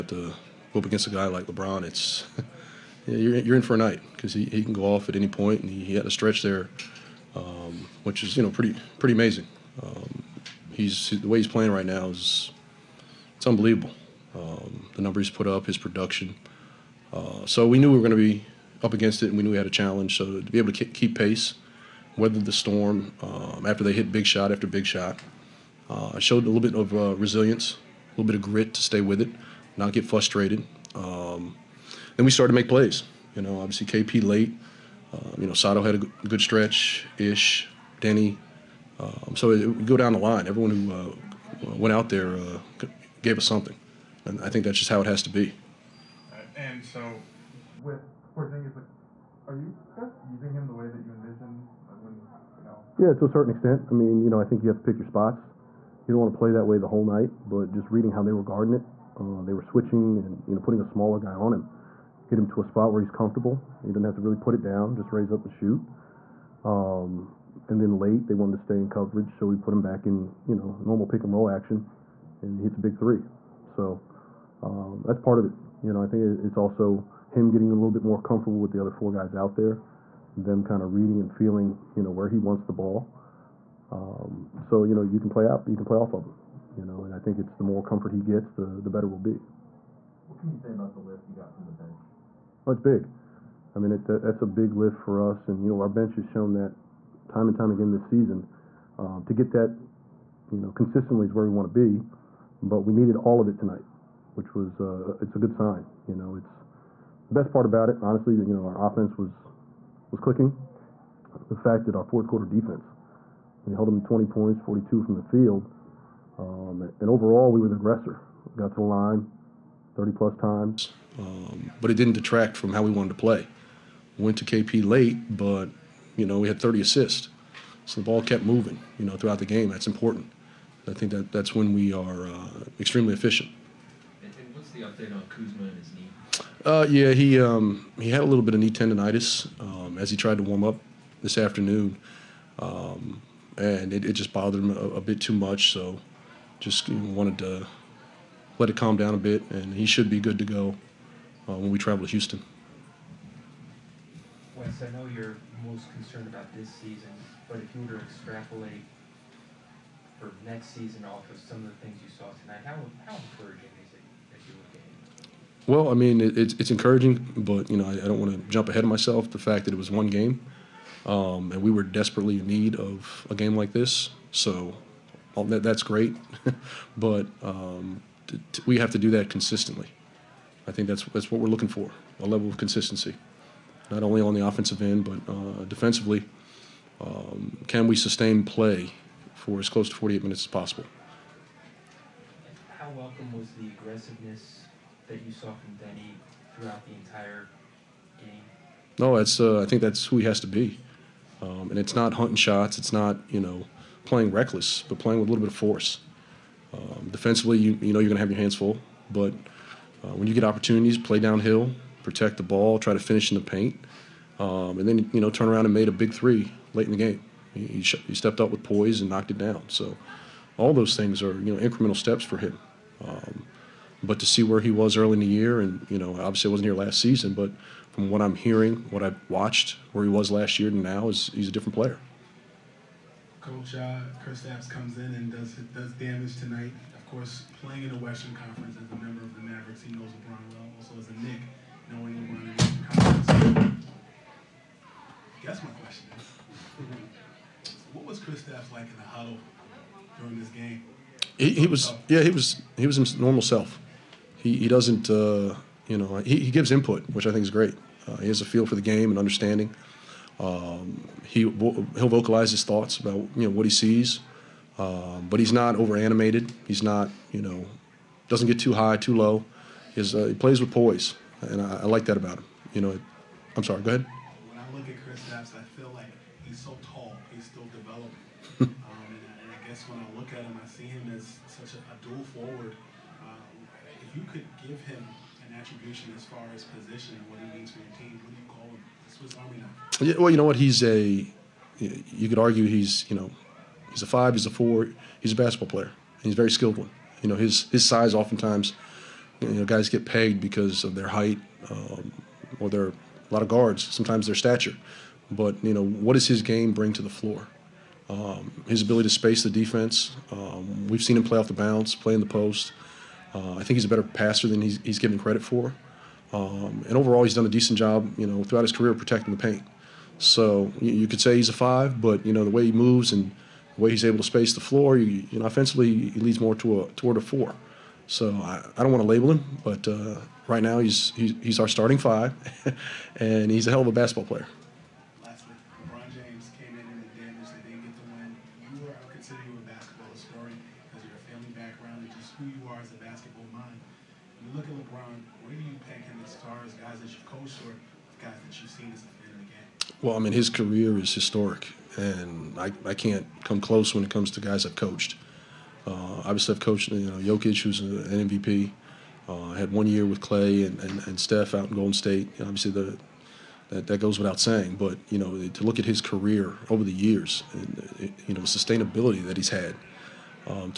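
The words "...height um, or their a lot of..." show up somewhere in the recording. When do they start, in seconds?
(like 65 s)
301 s.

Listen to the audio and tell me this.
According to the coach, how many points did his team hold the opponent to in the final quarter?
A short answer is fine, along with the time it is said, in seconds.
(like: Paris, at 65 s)
20, at 113 s.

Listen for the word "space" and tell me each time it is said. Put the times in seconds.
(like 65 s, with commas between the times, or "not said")
309 s, 324 s.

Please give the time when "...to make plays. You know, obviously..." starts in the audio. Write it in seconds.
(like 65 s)
32 s.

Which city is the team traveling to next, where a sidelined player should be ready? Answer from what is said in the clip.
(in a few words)
Houston.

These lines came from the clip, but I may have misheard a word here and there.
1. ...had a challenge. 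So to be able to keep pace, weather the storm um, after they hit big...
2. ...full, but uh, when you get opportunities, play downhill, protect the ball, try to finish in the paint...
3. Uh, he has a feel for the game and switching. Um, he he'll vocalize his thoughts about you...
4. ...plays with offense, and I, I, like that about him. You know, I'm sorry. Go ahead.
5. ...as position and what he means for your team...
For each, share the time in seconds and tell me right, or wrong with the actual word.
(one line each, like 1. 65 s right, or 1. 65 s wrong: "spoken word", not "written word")
1. 19 s right
2. 208 s right
3. 258 s wrong: "understanding", not "switching"
4. 270 s wrong: "poise", not "offense"
5. 286 s right.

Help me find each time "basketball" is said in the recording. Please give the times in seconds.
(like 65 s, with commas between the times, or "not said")
295 s, 333 s.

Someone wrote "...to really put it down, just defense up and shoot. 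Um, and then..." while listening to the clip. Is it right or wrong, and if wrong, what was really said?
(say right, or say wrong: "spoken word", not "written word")
wrong: "raise", not "defense".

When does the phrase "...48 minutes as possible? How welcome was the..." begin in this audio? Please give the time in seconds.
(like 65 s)
189 s.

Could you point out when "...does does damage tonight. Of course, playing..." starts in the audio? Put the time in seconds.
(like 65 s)
235 s.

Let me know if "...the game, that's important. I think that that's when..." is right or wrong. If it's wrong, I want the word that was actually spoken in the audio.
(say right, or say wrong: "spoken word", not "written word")
right.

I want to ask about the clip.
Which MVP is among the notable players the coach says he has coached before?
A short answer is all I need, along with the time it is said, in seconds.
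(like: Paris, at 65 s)
Jokic, at 357 s.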